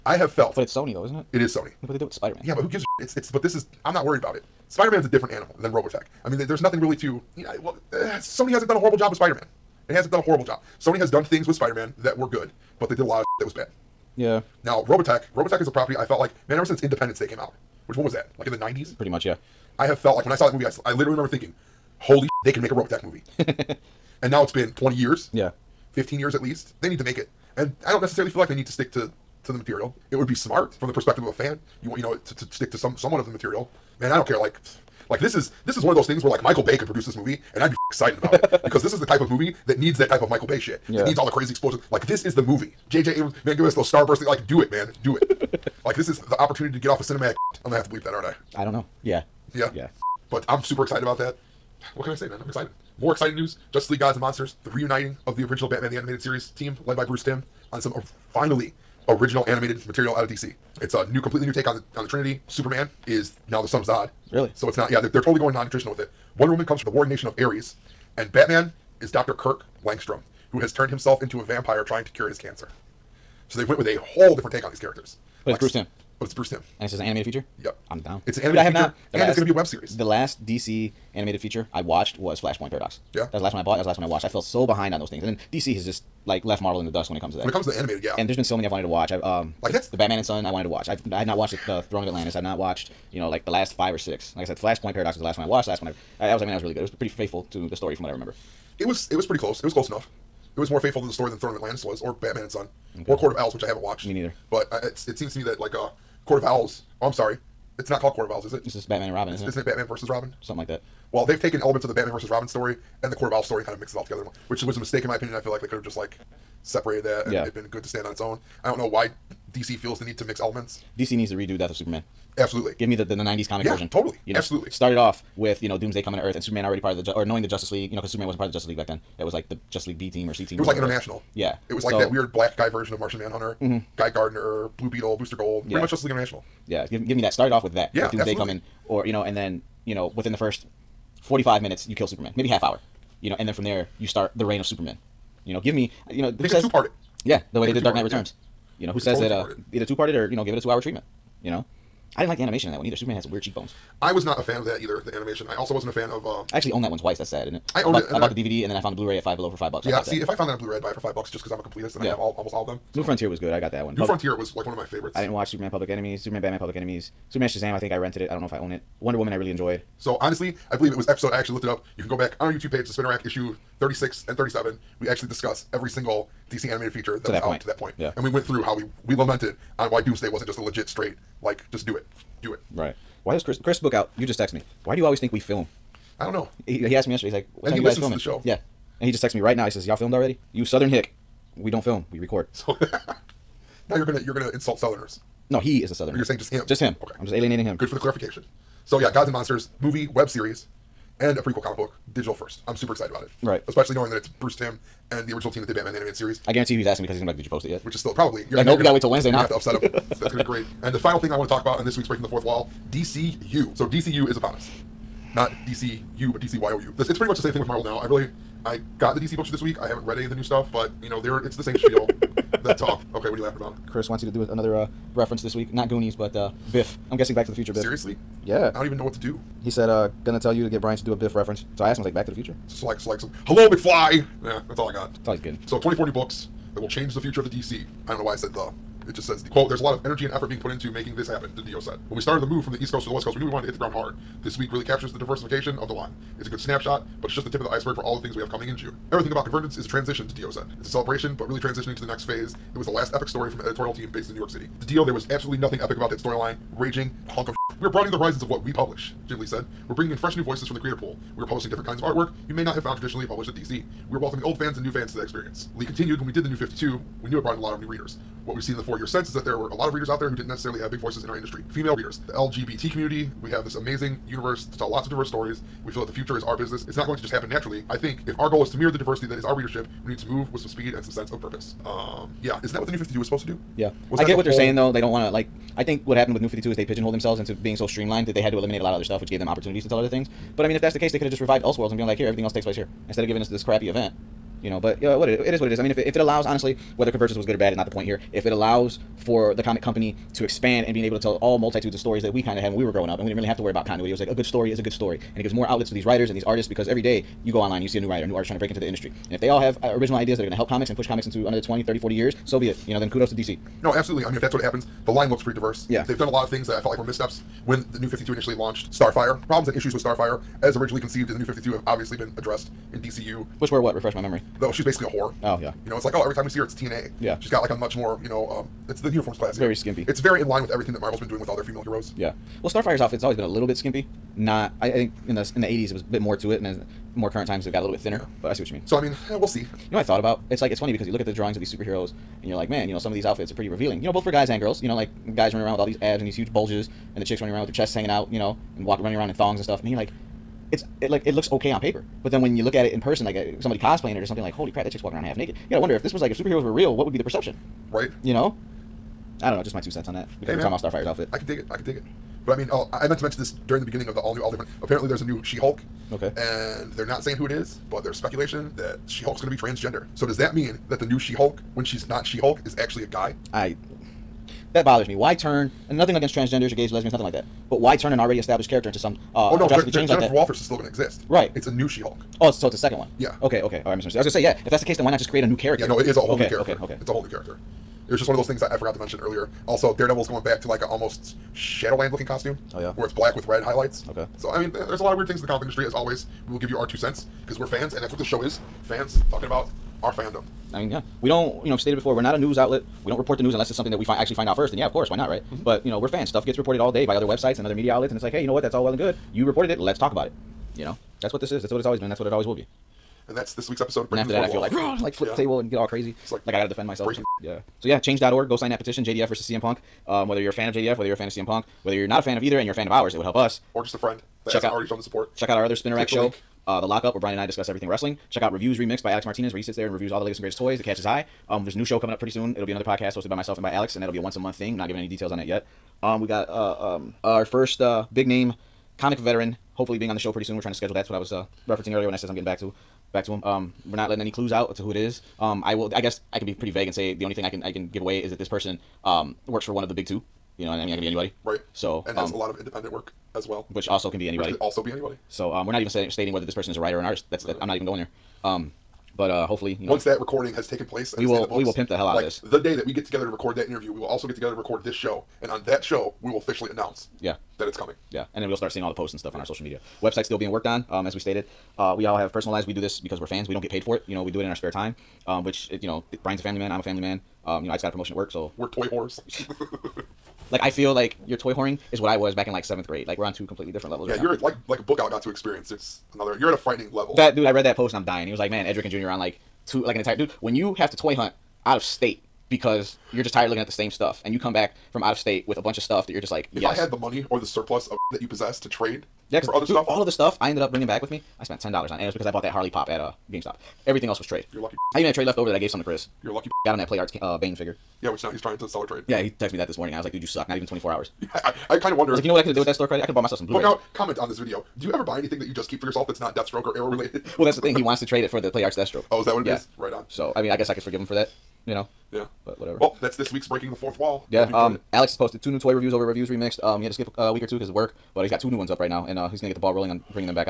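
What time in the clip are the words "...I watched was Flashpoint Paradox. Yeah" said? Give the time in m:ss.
1:21.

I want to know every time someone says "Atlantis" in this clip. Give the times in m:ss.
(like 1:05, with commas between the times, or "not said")
1:32, 1:41.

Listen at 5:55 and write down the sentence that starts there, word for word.
You gotta wonder if this was like if superheroes were real, what would be the perception?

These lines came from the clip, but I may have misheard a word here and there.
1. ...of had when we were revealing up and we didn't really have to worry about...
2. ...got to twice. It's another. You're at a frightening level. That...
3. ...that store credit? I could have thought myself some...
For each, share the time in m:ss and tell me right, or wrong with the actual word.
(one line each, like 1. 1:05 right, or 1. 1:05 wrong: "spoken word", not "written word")
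1. 5:02 wrong: "growing", not "revealing"
2. 8:05 wrong: "experience", not "twice"
3. 8:32 wrong: "bought", not "thought".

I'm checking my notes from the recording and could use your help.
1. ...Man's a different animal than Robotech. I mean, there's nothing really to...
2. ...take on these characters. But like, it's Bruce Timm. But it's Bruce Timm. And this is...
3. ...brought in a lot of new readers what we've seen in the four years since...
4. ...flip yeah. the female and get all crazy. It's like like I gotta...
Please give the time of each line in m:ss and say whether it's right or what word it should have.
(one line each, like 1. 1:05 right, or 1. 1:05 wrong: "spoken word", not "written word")
1. 0:04 right
2. 1:14 right
3. 4:27 right
4. 6:55 wrong: "table", not "female".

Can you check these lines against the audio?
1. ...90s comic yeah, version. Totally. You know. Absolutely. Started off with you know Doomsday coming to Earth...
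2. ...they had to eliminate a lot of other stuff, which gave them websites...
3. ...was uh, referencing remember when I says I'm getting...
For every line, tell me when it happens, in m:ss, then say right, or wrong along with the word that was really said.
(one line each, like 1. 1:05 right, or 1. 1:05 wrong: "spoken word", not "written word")
1. 2:03 right
2. 4:48 wrong: "opportunities", not "websites"
3. 7:21 wrong: "earlier", not "remember".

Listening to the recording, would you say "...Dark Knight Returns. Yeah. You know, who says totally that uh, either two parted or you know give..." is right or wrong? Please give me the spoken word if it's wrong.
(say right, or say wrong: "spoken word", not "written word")
right.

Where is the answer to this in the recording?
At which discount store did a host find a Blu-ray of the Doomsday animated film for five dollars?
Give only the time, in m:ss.
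2:39.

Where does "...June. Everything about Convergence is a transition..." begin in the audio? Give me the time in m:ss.
4:08.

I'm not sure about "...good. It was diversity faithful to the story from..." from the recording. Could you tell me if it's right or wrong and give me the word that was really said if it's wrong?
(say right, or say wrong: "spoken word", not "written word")
wrong: "pretty", not "diversity".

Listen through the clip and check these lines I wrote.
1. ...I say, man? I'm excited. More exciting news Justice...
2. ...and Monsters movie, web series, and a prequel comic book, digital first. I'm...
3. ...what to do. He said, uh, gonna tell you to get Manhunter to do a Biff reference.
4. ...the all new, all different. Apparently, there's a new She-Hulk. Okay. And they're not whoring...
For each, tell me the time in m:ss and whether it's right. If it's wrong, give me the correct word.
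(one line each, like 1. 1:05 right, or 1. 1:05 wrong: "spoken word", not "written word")
1. 0:52 right
2. 3:19 right
3. 3:49 wrong: "Brian", not "Manhunter"
4. 6:04 wrong: "saying", not "whoring".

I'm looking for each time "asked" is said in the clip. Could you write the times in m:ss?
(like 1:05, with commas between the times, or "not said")
3:06, 3:51.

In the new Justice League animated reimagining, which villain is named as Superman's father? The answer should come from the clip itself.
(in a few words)
Zod.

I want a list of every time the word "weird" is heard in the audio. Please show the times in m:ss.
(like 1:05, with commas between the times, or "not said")
2:12, 2:33, 6:35.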